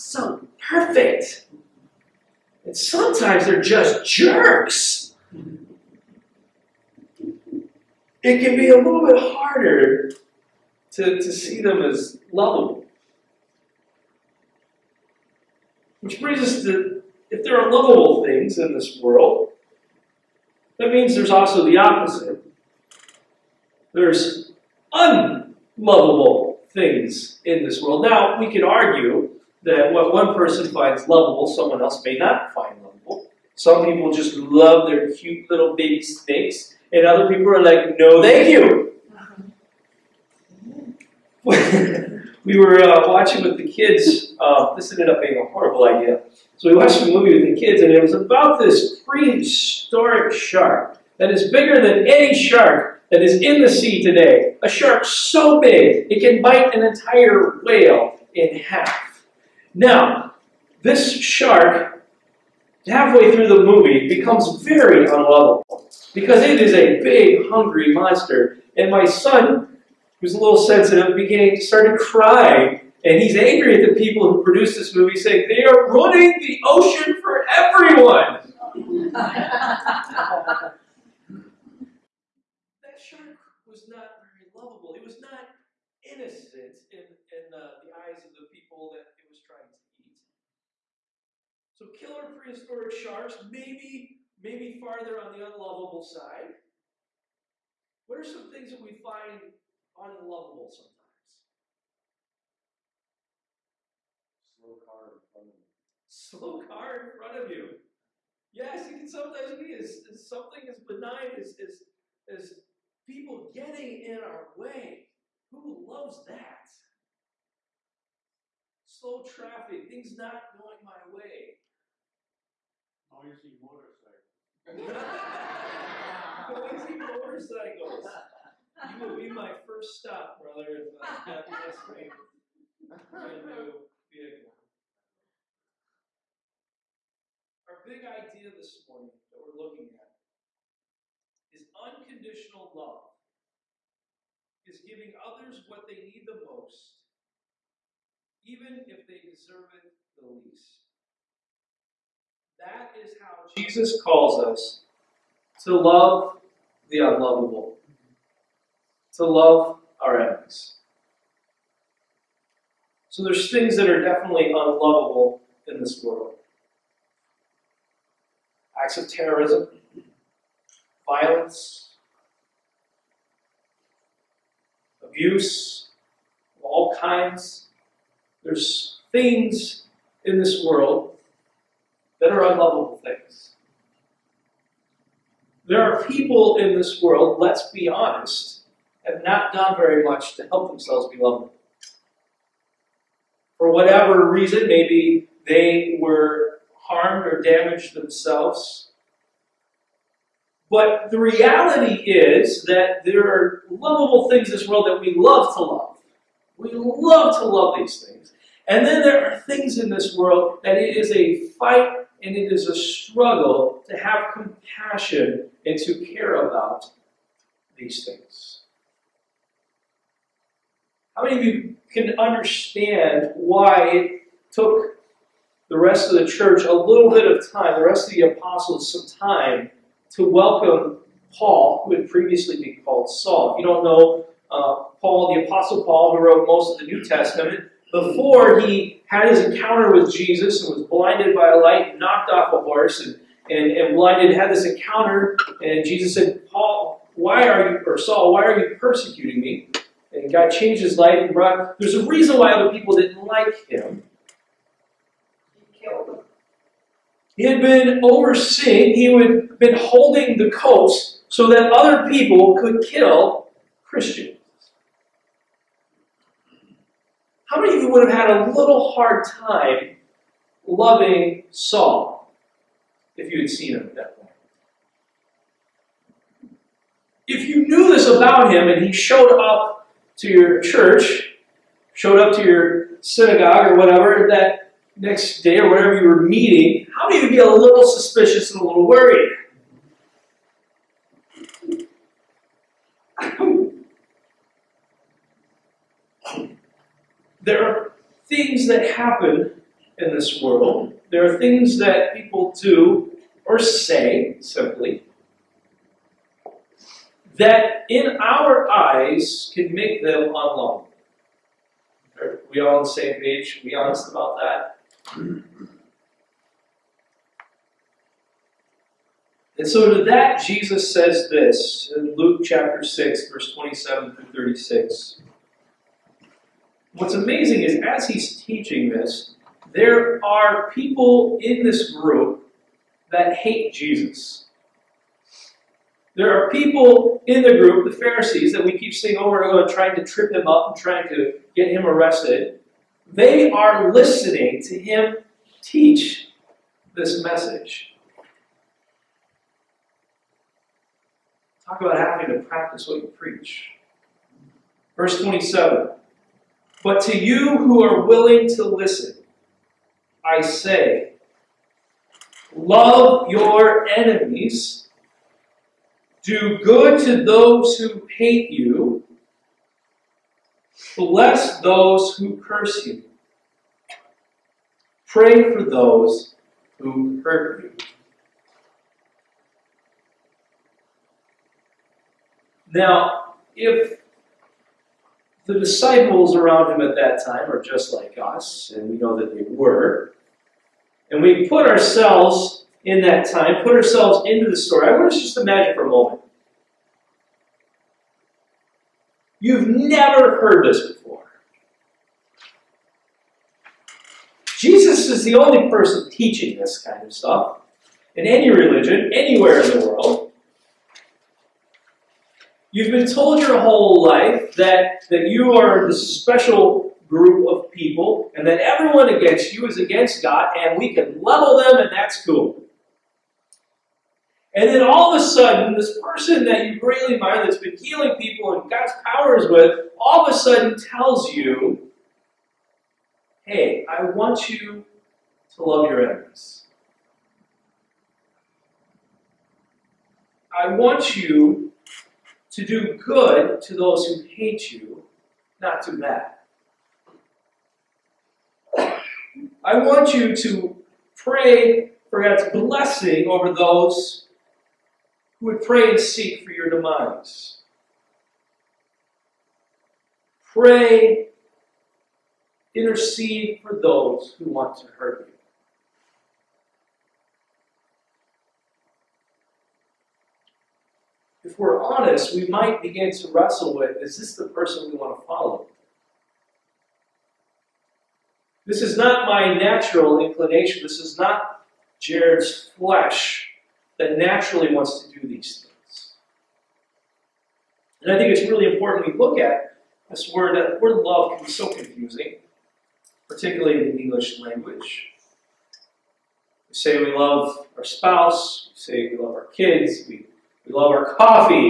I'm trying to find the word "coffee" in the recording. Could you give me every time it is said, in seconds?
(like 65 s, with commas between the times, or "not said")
501 s.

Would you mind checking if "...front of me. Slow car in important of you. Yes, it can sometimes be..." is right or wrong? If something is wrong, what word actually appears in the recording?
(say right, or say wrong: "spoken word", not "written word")
wrong: "front", not "important".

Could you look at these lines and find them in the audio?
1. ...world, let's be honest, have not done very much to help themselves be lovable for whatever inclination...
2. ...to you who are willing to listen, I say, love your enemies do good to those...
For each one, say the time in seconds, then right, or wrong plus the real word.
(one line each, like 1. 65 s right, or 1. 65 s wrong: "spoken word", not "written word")
1. 187 s wrong: "reason", not "inclination"
2. 357 s right.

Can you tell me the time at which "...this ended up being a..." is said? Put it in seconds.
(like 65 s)
44 s.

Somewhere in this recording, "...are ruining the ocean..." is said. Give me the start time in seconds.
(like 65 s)
75 s.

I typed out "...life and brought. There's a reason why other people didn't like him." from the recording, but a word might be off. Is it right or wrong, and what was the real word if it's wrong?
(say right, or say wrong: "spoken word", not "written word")
right.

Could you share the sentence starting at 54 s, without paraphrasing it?
A shark so big, it can bite an entire whale in half.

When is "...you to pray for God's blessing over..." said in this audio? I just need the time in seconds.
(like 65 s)
450 s.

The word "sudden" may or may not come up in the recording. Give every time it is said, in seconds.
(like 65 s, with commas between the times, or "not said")
425 s, 430 s.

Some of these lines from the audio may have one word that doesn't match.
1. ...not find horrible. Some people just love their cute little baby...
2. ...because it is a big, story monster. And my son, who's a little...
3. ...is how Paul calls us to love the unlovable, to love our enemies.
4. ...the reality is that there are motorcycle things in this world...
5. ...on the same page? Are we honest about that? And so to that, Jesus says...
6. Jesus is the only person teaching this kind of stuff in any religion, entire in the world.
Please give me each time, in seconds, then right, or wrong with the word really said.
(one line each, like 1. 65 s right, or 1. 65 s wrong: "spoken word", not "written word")
1. 32 s wrong: "lovable", not "horrible"
2. 66 s wrong: "hungry", not "story"
3. 152 s wrong: "Jesus", not "Paul"
4. 201 s wrong: "lovable", not "motorcycle"
5. 312 s right
6. 404 s wrong: "anywhere", not "entire".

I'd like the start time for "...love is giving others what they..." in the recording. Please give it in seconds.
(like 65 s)
142 s.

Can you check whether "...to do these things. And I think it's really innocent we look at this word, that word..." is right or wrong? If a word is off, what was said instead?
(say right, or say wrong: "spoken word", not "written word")
wrong: "important", not "innocent".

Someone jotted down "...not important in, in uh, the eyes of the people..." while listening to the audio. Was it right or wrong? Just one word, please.
wrong.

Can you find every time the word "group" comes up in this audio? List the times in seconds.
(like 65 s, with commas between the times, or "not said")
331 s, 337 s, 417 s.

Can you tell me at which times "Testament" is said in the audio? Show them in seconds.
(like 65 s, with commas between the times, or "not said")
237 s.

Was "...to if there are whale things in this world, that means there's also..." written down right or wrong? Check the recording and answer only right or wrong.
wrong.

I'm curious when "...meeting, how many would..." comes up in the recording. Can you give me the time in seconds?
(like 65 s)
286 s.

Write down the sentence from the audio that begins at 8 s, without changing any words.
It can be a little bit harder to, to see them as lovable.